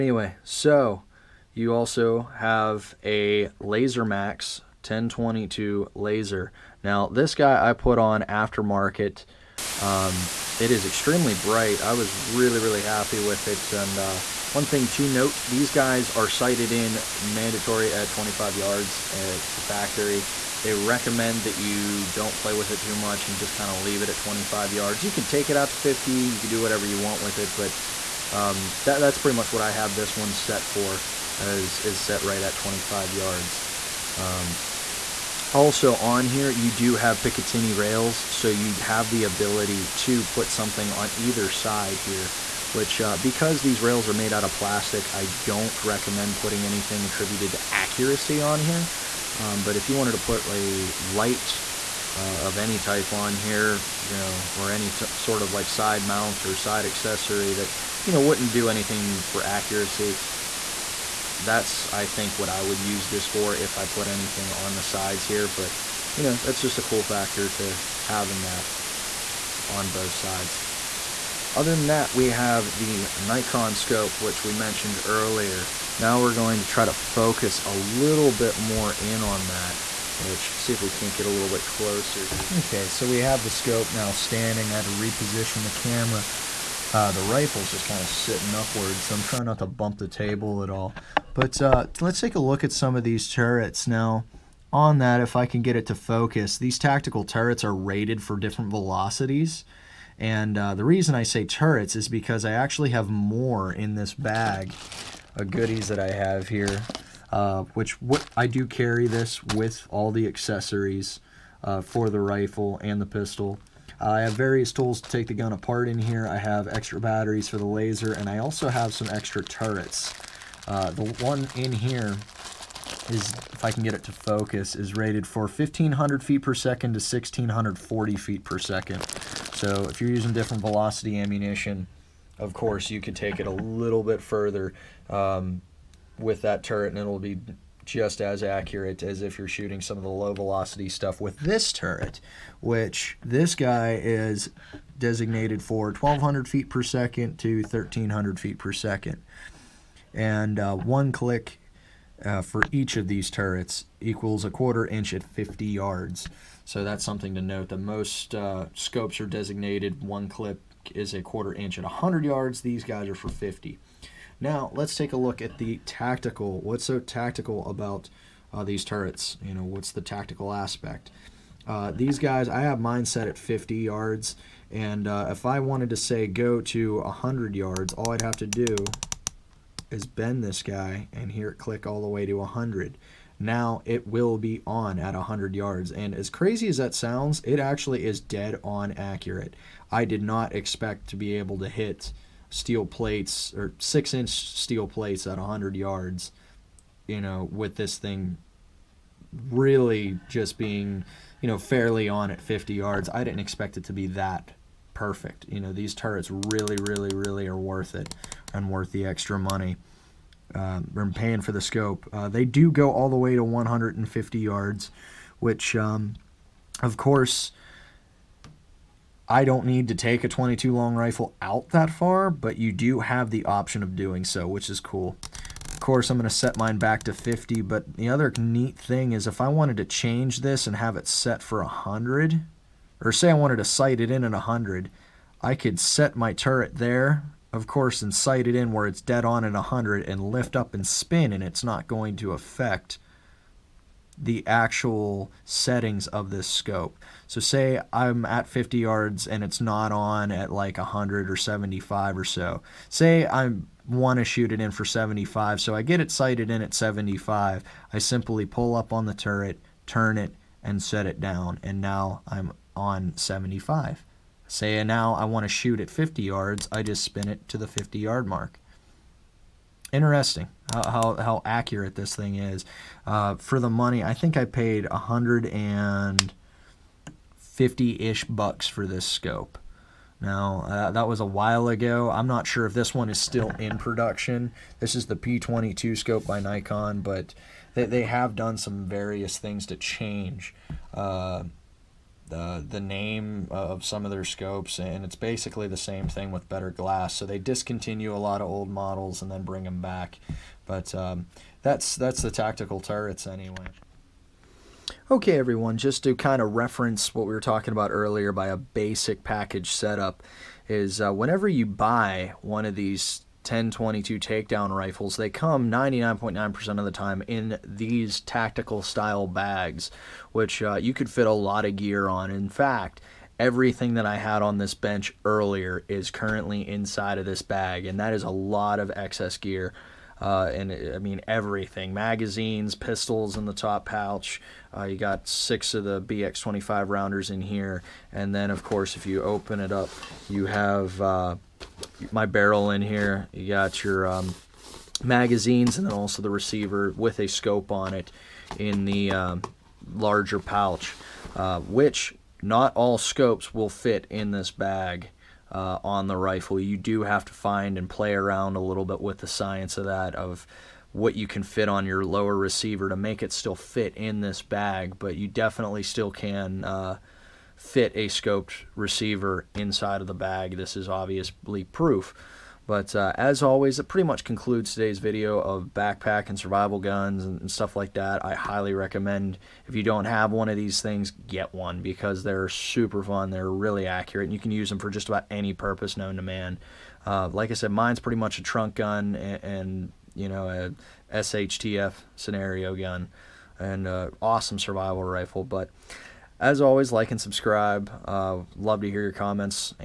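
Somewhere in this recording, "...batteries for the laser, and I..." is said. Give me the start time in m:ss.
1:56.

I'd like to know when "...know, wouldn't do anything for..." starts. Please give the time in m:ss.
0:58.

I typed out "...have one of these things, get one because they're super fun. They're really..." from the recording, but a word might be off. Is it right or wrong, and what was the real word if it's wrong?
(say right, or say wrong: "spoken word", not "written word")
right.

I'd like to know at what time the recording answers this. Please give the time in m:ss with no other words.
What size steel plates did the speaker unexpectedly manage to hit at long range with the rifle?
3:13.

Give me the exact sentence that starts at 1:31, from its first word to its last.
But uh, let's take a look at some of these turrets.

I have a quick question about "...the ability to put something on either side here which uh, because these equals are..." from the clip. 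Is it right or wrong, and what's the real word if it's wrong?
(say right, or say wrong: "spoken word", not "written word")
wrong: "rails", not "equals".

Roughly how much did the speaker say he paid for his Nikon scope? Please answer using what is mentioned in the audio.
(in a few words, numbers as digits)
$150.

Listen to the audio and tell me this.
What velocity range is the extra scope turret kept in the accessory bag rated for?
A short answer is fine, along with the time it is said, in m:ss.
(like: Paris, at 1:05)
1500 to 1640 feet per second, at 2:05.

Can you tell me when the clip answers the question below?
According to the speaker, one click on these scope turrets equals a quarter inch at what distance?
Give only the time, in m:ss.
2:34.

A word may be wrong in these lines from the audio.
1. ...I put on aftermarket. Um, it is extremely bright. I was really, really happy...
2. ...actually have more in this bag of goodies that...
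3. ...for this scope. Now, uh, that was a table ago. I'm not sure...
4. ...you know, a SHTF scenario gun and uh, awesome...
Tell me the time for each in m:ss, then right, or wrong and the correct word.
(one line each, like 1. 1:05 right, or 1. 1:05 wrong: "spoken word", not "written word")
1. 0:07 right
2. 1:42 right
3. 4:38 wrong: "while", not "table"
4. 6:30 right.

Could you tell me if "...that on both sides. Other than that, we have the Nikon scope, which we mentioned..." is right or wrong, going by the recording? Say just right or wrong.
right.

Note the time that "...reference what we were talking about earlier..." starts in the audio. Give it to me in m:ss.
5:06.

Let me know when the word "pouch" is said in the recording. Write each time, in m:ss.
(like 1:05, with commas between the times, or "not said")
5:33, 5:50.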